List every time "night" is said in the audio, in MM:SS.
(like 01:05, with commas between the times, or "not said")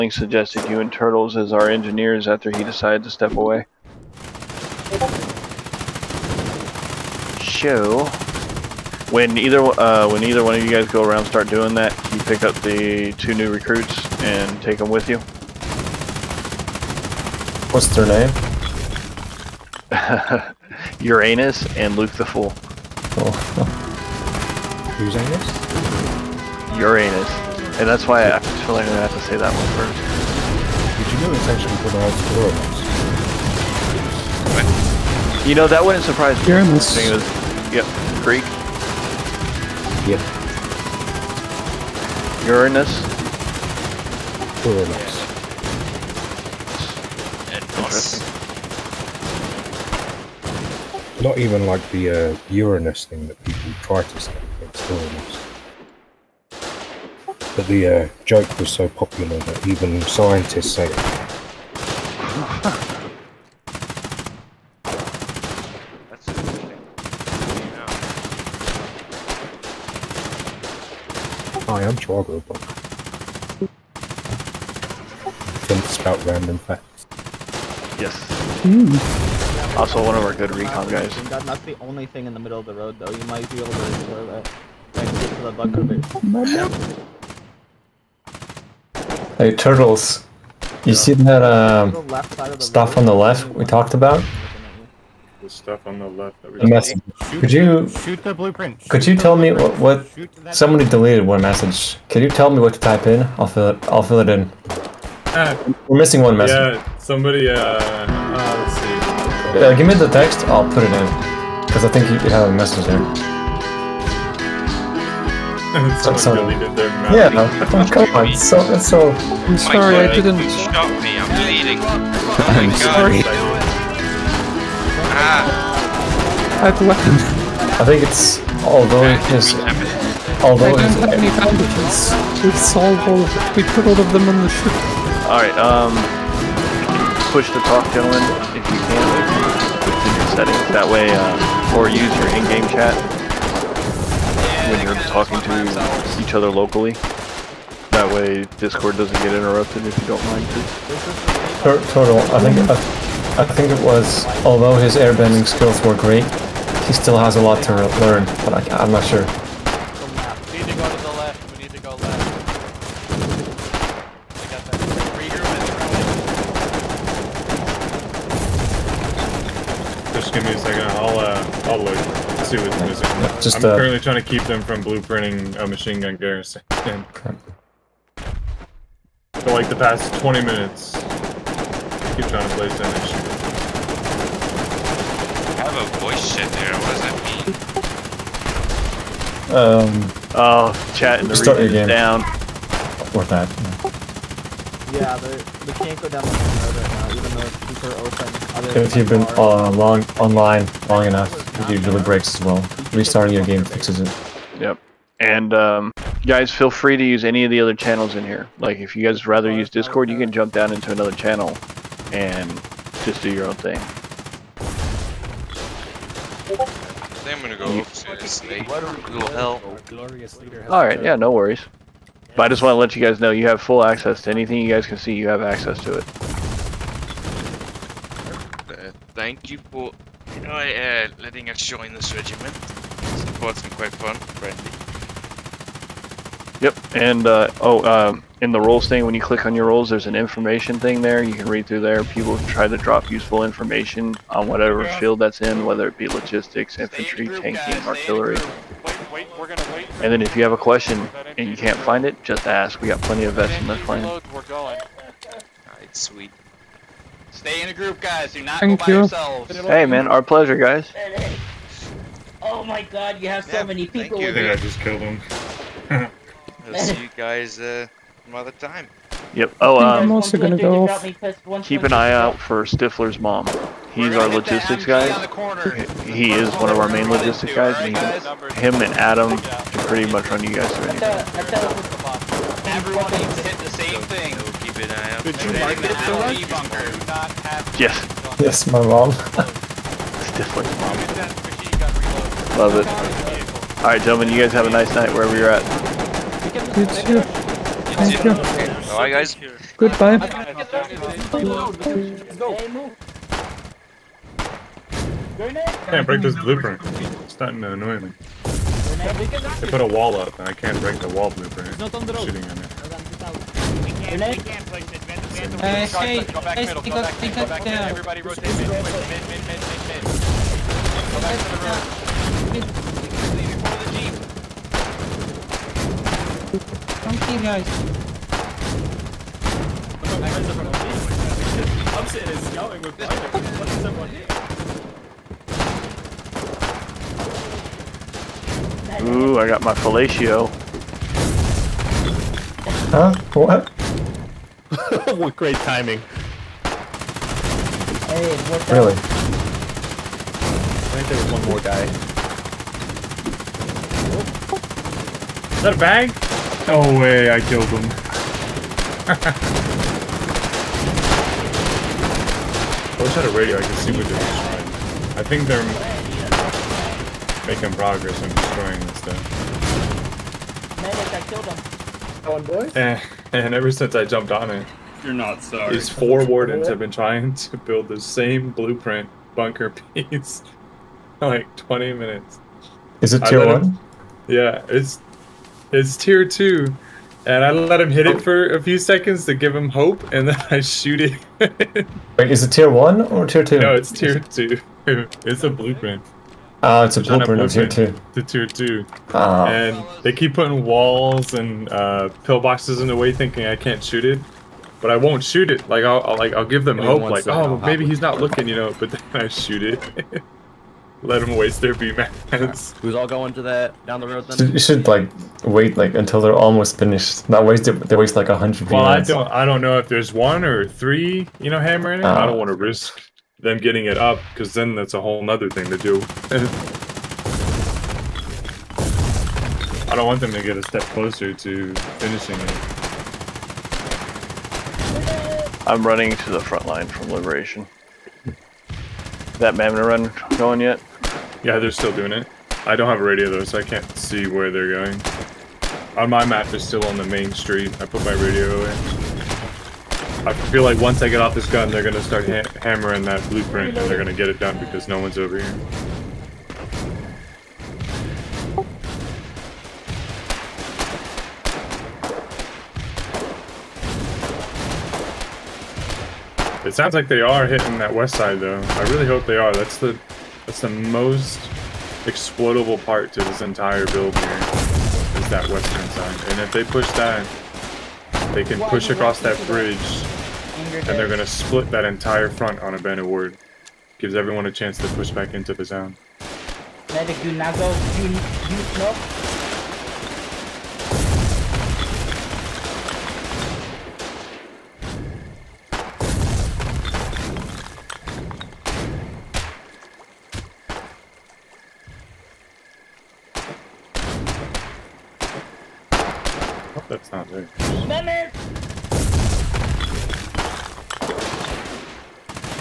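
04:54.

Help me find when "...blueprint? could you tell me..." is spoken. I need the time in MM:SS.
01:38.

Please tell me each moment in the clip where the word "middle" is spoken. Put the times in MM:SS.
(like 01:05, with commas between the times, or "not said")
01:22, 05:16.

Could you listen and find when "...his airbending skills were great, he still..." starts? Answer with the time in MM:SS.
02:34.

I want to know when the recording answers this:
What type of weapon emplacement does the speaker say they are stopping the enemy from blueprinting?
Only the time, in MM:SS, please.
02:55.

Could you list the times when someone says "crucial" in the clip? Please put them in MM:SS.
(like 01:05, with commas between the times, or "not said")
not said.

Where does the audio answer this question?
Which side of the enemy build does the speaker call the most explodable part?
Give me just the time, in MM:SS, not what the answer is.
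07:55.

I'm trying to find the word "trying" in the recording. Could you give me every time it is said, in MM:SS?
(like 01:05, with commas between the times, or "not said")
02:54, 03:02, 06:16.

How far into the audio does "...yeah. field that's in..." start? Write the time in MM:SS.
04:04.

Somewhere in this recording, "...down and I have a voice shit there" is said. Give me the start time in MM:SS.
03:02.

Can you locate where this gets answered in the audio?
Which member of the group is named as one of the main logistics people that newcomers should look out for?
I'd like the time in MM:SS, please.
04:32.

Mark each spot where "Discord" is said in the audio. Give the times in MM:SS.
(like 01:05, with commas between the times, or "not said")
02:28, 03:29.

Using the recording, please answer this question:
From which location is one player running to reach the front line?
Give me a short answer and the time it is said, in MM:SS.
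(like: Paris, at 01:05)
Liberation, at 07:17.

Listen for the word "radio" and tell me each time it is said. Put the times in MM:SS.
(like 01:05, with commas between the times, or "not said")
06:03, 07:23, 07:28.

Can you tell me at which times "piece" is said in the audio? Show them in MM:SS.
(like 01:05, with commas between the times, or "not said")
06:19.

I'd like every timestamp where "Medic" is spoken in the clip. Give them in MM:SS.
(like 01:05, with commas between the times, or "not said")
06:10, 08:06, 08:27.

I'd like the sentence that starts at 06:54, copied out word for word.
You should like wait like until they're almost finished.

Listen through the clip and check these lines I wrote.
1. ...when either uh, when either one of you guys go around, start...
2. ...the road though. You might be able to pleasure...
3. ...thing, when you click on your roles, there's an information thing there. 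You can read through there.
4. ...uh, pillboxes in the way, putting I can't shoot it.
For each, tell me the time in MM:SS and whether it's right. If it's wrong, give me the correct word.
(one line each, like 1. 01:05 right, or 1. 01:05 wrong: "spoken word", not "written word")
1. 00:09 right
2. 01:22 wrong: "explore", not "pleasure"
3. 03:58 right
4. 06:41 wrong: "thinking", not "putting".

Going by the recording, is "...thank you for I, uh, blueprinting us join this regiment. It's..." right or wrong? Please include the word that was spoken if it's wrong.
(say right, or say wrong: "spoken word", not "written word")
wrong: "letting", not "blueprinting".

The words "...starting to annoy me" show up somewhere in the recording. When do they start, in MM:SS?
05:07.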